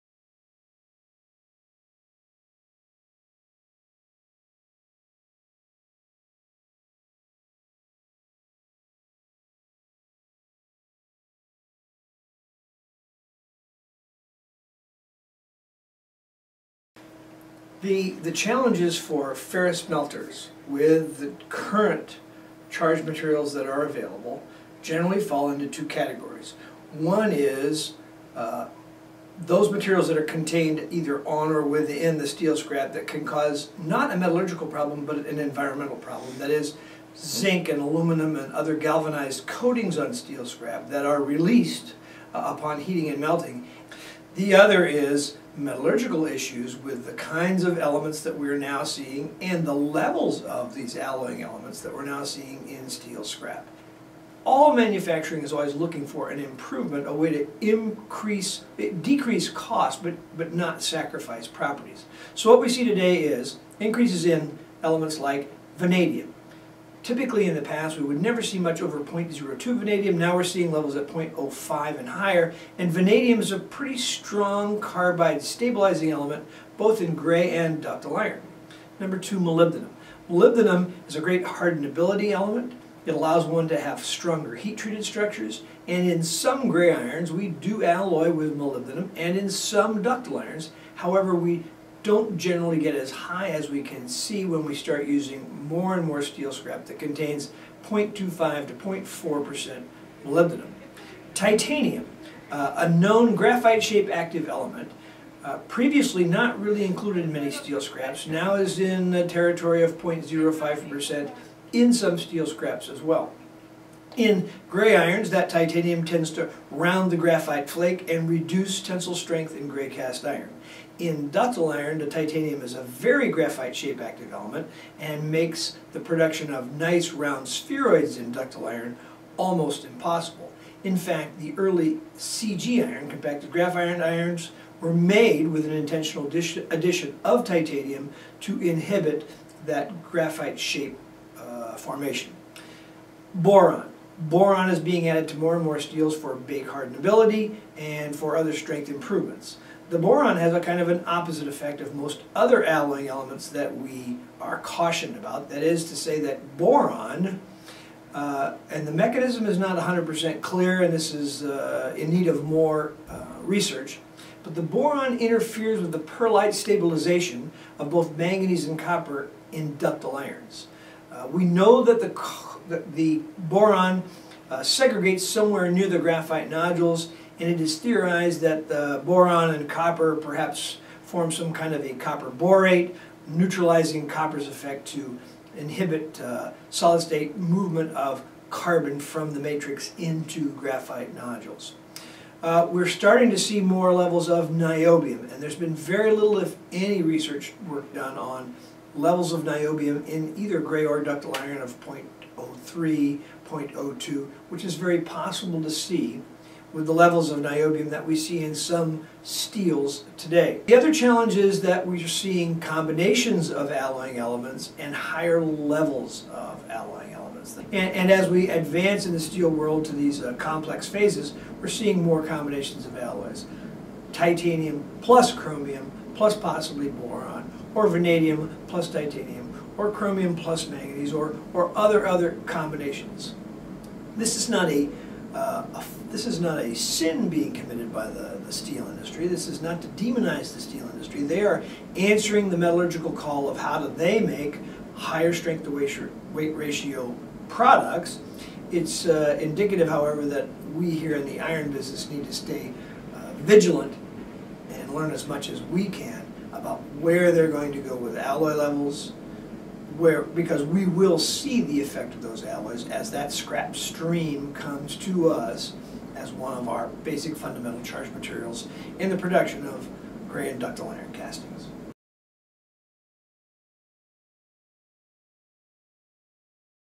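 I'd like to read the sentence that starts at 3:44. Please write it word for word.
Titanium plus chromium plus possibly boron, or vanadium plus titanium, or chromium plus manganese, or, or other other combinations.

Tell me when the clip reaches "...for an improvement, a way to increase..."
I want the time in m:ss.
0:56.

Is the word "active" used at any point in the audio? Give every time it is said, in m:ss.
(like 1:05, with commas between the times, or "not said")
1:44, 2:03.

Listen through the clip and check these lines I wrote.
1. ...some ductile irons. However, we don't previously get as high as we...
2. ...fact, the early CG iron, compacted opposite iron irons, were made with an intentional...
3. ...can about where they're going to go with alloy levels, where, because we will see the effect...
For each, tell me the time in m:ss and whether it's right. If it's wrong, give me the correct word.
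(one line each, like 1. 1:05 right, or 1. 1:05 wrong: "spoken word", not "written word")
1. 1:29 wrong: "generally", not "previously"
2. 2:10 wrong: "graphite", not "opposite"
3. 4:15 right.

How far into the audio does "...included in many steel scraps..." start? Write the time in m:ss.
1:46.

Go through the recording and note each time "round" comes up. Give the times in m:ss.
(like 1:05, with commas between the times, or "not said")
1:56, 2:07.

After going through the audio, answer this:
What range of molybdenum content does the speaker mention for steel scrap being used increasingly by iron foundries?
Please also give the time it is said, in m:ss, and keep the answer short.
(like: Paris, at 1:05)
0.25 to 0.4%, at 1:37.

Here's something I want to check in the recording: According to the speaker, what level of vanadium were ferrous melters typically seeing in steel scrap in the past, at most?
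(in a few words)
0.02.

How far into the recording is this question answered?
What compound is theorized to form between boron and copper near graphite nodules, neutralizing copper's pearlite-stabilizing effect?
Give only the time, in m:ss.
3:01.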